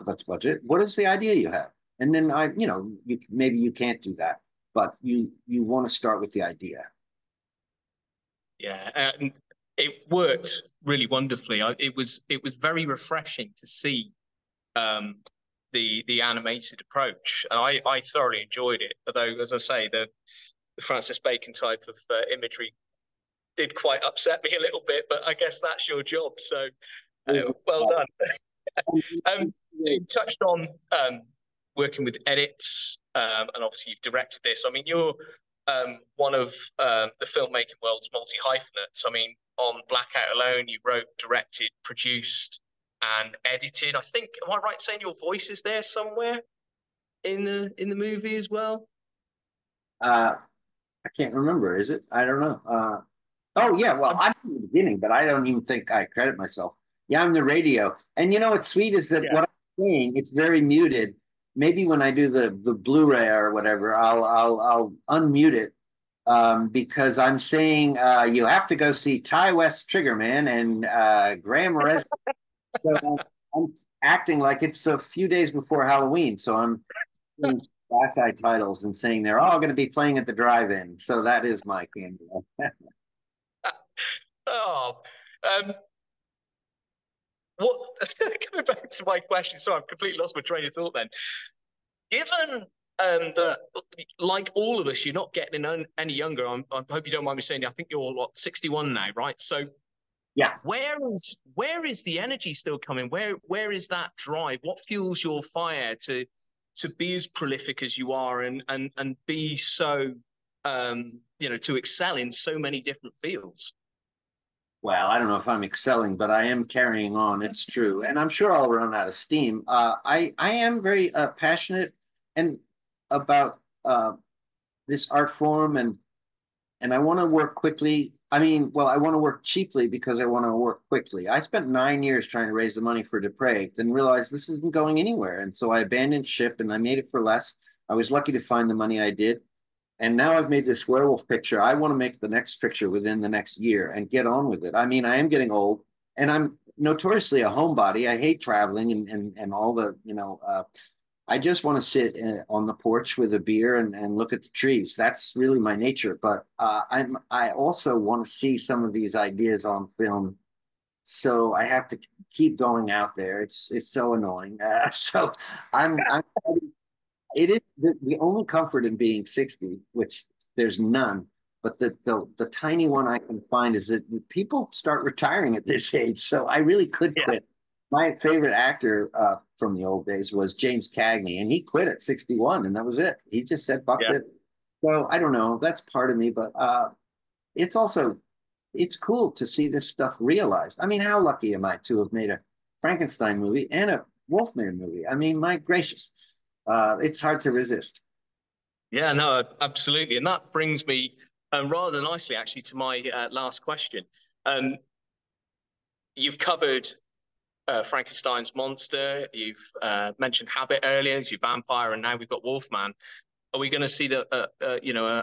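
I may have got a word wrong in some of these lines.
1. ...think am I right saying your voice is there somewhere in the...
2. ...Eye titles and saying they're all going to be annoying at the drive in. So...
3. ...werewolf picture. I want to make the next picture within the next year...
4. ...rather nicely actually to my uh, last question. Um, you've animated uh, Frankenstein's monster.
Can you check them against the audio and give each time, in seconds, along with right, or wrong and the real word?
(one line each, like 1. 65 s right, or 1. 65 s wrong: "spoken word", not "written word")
1. 43 s right
2. 78 s wrong: "playing", not "annoying"
3. 140 s right
4. 201 s wrong: "covered", not "animated".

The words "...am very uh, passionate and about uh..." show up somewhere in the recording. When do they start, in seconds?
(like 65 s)
120 s.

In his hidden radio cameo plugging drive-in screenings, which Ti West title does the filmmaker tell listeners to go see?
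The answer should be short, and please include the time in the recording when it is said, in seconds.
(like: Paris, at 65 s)
Triggerman, at 69 s.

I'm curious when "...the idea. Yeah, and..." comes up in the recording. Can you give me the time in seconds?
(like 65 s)
6 s.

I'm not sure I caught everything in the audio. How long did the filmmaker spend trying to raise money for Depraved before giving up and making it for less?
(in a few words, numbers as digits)
9 years.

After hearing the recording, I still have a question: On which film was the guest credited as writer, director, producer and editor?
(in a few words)
Blackout.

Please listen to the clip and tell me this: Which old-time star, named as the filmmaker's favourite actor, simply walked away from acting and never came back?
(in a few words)
James Cagney.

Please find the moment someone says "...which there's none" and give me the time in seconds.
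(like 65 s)
169 s.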